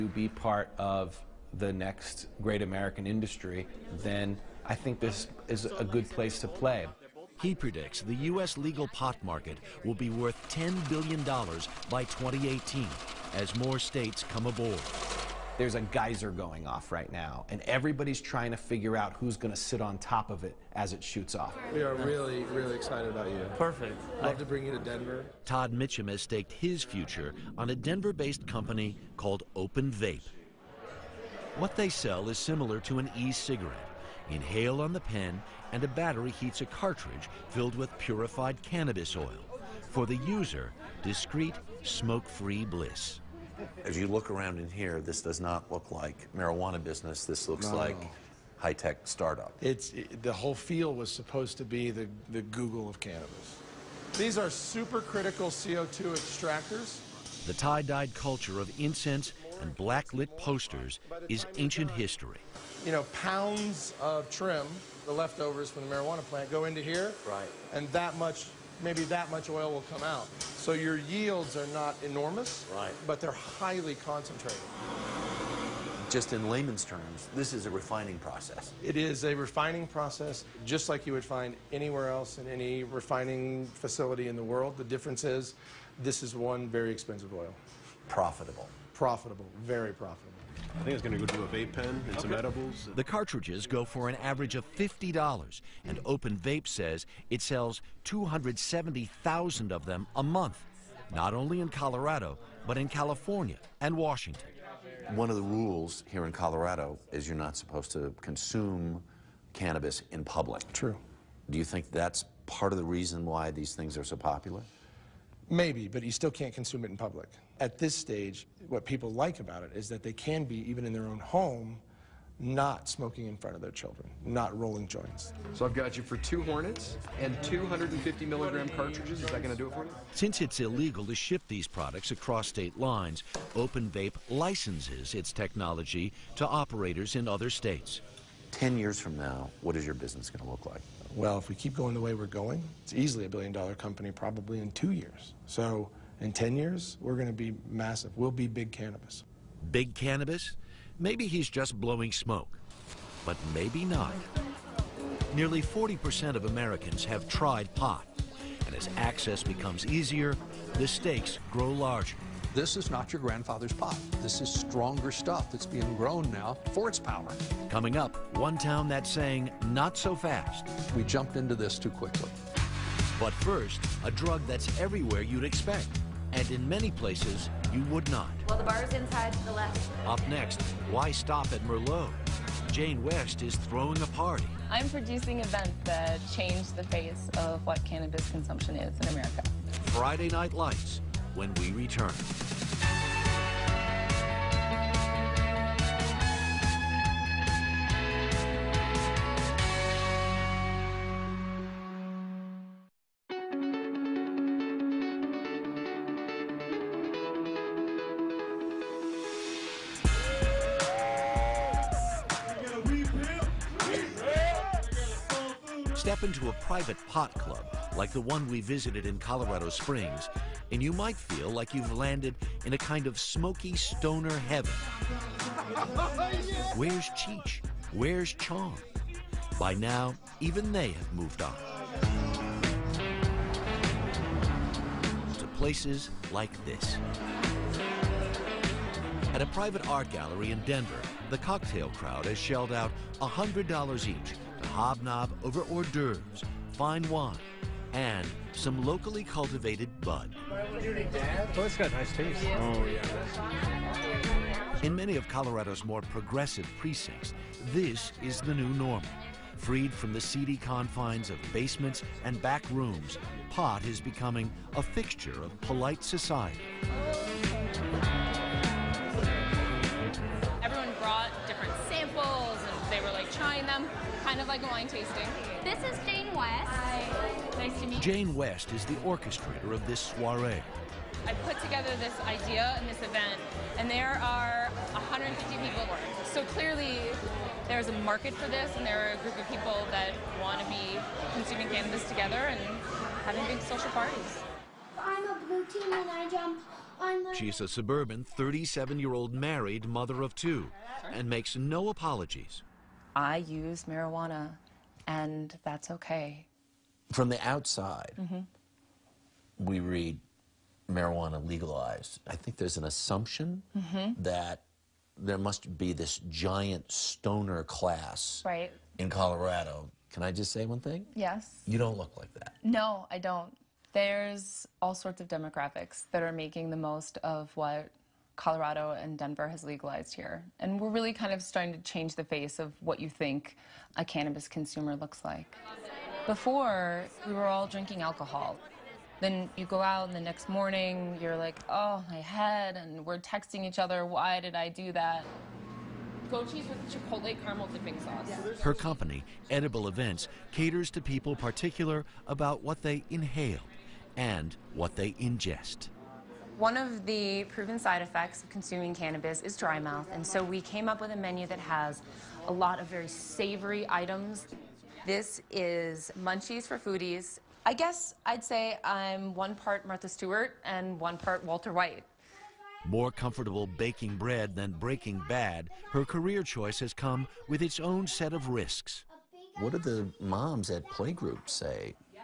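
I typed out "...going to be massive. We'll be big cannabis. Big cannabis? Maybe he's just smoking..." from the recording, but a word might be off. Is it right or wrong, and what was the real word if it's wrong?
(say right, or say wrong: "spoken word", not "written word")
wrong: "blowing", not "smoking".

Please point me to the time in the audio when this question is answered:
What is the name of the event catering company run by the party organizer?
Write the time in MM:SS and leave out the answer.
05:49.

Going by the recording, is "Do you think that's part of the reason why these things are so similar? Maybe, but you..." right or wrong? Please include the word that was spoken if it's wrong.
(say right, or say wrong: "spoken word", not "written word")
wrong: "popular", not "similar".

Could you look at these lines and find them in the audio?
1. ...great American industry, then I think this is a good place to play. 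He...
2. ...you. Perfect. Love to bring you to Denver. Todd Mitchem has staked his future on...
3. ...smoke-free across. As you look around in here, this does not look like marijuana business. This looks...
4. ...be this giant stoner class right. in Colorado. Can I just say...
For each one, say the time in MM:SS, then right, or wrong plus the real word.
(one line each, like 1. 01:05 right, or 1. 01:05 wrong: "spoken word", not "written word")
1. 00:02 right
2. 00:23 right
3. 00:41 wrong: "bliss", not "across"
4. 05:15 right.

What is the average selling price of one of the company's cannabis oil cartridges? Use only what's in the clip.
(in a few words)
$50.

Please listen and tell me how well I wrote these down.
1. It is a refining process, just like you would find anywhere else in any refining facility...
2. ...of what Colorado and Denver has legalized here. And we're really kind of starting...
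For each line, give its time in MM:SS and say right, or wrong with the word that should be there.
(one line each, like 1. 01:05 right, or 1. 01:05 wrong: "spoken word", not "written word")
1. 01:18 right
2. 05:27 right.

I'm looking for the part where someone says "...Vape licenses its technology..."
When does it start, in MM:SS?
02:13.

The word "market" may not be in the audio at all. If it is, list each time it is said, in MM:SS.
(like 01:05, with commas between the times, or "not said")
00:09, 04:47.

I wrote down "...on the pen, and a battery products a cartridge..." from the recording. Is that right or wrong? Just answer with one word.
wrong.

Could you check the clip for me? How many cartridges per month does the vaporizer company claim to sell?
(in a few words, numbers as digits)
270,000.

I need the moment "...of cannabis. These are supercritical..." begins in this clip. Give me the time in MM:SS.
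00:52.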